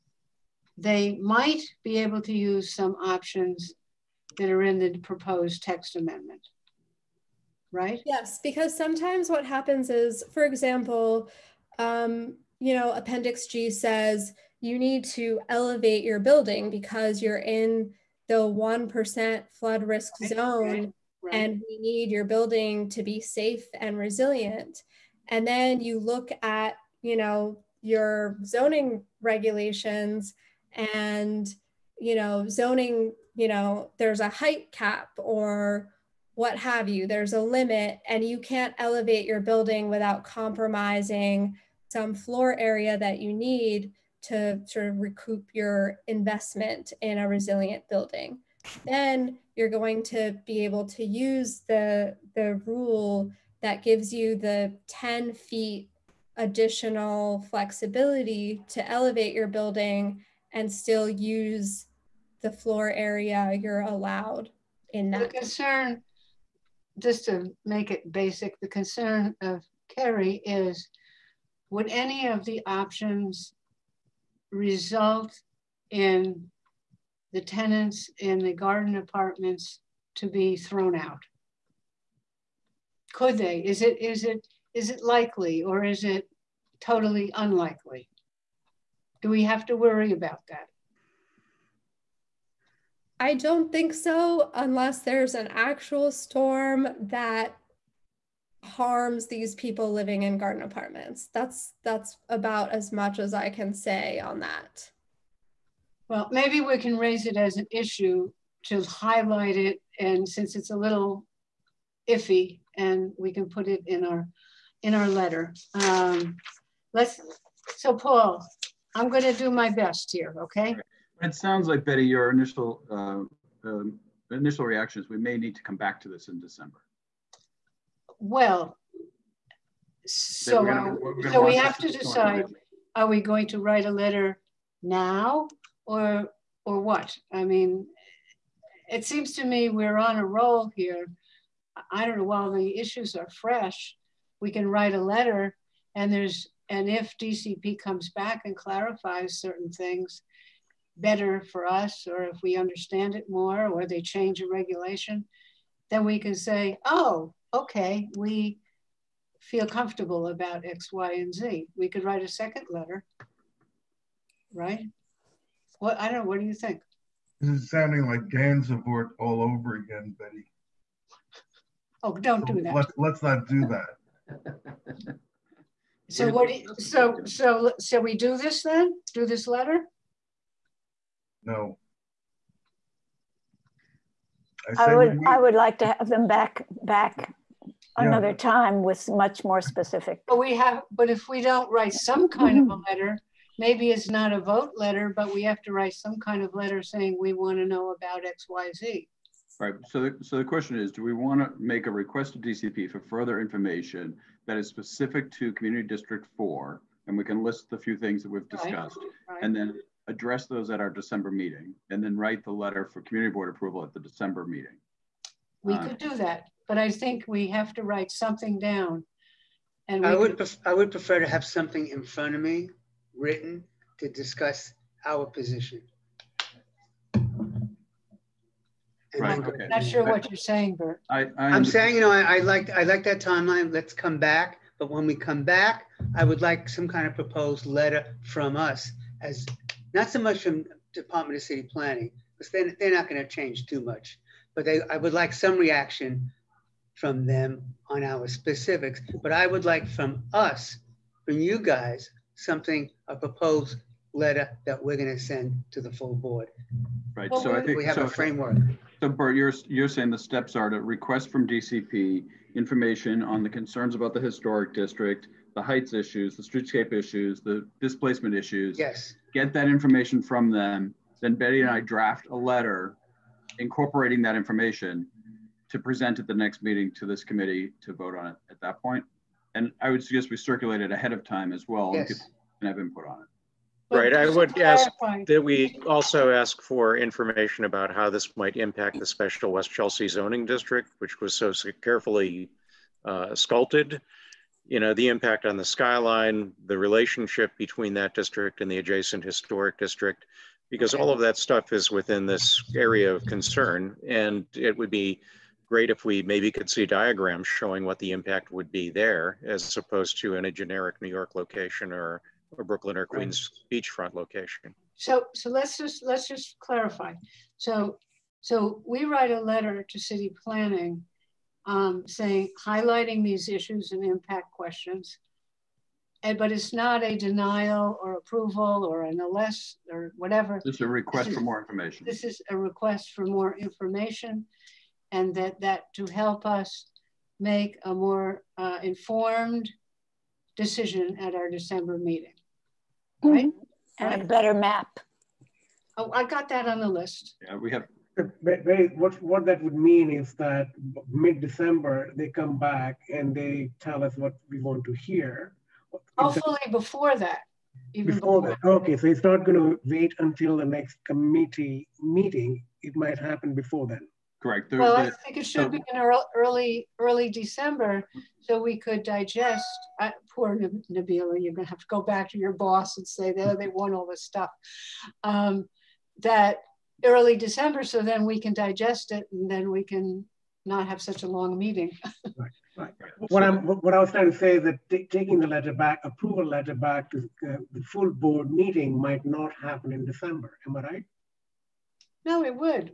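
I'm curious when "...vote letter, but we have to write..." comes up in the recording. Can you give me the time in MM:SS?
03:14.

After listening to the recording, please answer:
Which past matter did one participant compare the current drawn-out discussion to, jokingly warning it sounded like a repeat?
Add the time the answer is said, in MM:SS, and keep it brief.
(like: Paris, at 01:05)
Gansevoort, at 02:48.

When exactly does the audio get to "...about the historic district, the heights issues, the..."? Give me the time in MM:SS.
04:23.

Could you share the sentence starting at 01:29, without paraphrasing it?
Do we have to worry about that?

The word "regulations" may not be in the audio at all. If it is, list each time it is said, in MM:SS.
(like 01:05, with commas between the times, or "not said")
00:29, 02:34.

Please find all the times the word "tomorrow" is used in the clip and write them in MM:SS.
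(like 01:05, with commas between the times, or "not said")
not said.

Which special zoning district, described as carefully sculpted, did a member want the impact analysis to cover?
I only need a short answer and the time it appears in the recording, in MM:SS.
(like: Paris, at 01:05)
West Chelsea, at 04:49.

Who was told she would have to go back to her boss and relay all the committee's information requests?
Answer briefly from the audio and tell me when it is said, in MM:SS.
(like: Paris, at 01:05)
Nabila, at 06:10.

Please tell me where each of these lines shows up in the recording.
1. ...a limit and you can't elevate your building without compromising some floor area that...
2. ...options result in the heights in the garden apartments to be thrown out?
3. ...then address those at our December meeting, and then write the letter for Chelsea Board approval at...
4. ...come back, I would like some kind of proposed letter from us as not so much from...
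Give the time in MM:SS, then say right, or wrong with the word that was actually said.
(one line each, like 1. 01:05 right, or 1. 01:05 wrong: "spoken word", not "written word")
1. 00:37 right
2. 01:12 wrong: "tenants", not "heights"
3. 03:29 wrong: "Community", not "Chelsea"
4. 03:55 right.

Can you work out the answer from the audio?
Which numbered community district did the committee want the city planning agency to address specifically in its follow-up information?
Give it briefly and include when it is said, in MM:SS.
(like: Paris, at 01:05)
Community District 4, at 03:25.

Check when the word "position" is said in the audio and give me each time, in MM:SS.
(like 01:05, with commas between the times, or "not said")
03:45.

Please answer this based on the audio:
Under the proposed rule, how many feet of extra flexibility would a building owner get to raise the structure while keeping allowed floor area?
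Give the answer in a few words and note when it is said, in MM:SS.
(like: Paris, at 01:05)
10 feet, at 00:54.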